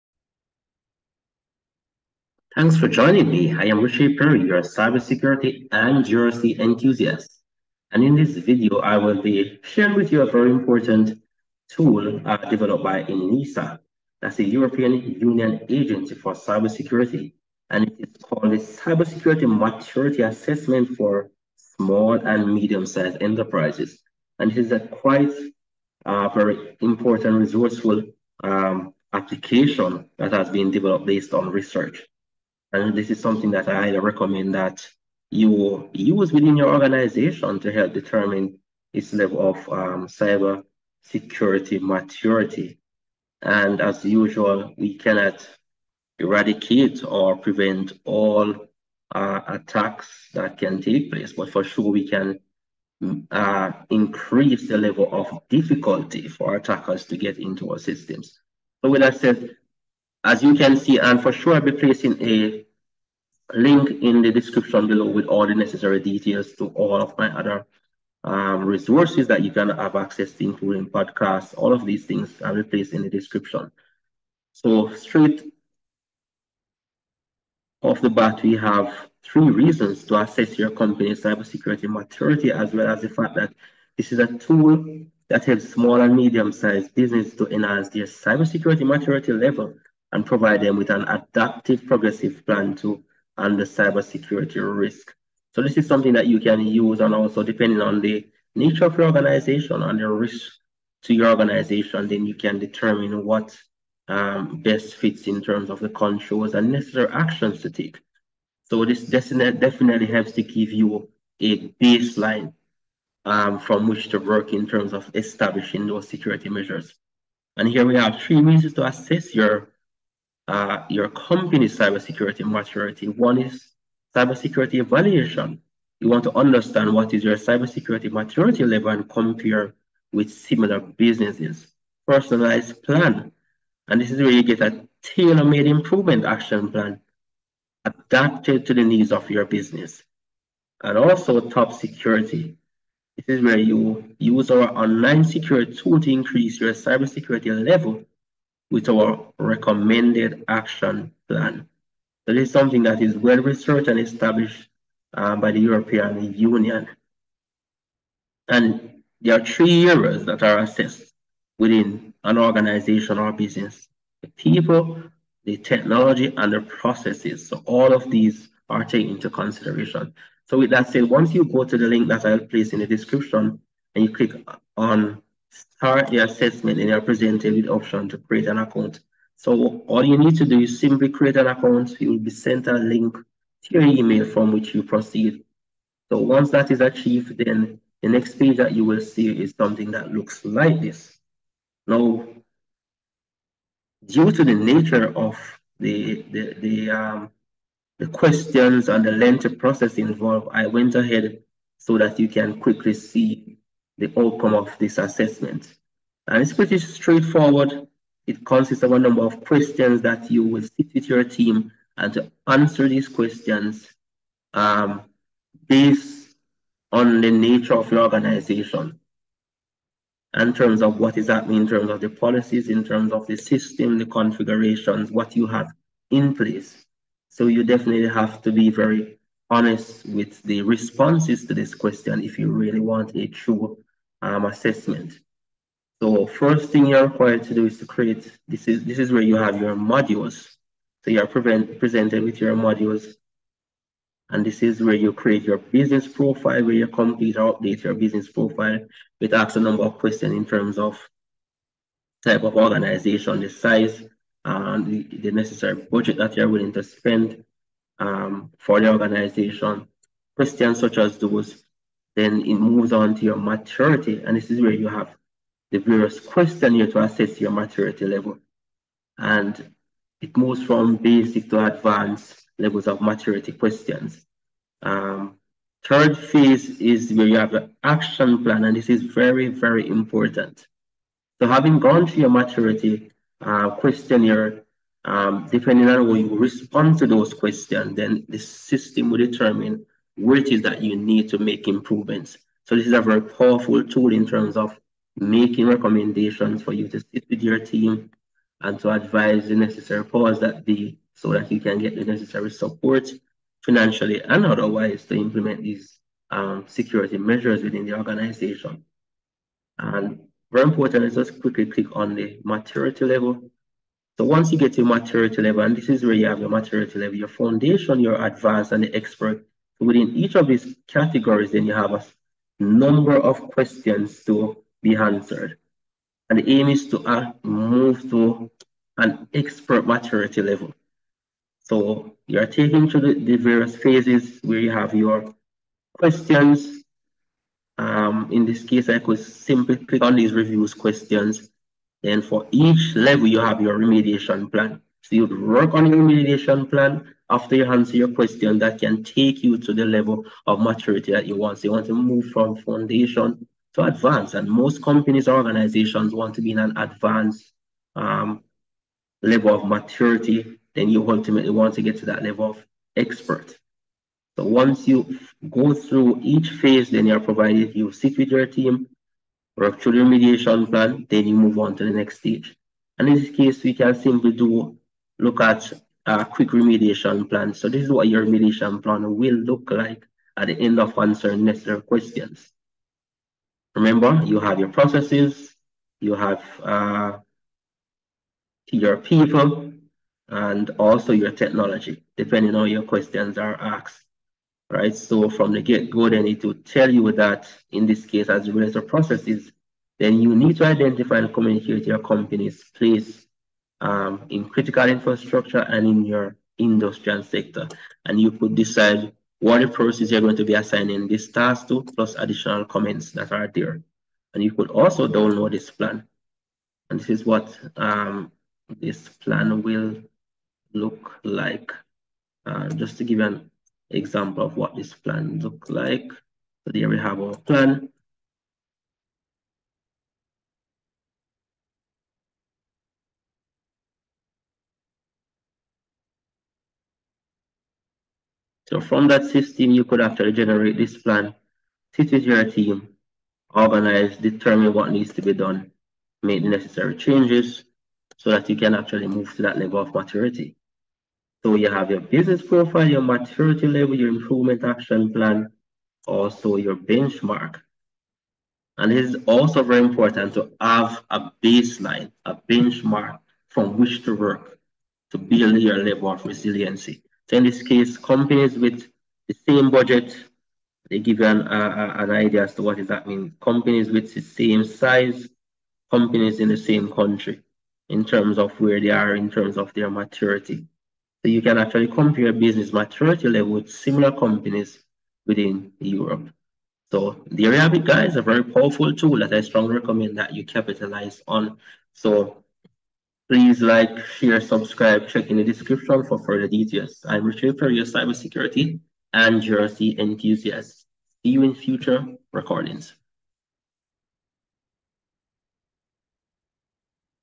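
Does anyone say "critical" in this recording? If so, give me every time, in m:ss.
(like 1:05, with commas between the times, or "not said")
6:44.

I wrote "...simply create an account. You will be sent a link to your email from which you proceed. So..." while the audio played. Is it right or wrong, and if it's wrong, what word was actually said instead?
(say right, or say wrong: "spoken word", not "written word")
right.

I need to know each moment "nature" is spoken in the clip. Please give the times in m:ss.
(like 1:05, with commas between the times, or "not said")
1:38, 3:14, 3:37.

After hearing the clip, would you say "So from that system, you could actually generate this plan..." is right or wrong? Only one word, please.
right.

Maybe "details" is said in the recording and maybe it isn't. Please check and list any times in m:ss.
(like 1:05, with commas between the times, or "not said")
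1:05, 8:16.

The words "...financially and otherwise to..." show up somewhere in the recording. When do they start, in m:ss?
5:03.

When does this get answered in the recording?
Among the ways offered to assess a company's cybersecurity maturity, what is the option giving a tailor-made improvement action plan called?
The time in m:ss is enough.
2:12.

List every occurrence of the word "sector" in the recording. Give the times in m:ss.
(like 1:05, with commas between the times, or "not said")
6:47.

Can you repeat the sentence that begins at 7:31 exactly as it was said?
So you have your business profile, your maturity level, your improvement action plan, also your benchmark.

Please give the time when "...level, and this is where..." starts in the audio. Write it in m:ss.
5:15.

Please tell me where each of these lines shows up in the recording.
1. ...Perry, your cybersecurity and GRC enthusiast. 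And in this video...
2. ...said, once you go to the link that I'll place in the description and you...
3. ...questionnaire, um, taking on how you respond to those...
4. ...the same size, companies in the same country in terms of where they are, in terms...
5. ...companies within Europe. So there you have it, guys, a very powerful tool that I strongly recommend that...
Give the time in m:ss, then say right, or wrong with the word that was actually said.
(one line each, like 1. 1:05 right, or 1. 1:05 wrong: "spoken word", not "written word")
1. 0:04 right
2. 2:50 right
3. 4:43 wrong: "depending", not "taking"
4. 7:54 right
5. 8:04 right.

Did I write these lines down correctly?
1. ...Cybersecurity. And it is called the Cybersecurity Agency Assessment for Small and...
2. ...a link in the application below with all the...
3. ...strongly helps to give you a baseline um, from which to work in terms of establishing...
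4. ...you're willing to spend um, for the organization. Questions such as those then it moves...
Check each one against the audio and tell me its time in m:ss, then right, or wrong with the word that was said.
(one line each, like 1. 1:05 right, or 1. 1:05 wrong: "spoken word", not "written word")
1. 0:16 wrong: "Maturity", not "Agency"
2. 1:02 wrong: "description", not "application"
3. 1:49 wrong: "definitely", not "strongly"
4. 4:16 right.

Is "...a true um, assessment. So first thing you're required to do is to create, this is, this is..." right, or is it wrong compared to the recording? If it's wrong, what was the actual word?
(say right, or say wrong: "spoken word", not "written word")
right.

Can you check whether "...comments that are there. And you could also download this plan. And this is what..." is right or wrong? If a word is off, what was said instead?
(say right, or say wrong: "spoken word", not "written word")
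right.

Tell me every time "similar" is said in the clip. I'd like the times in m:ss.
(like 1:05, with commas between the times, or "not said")
2:10, 8:03.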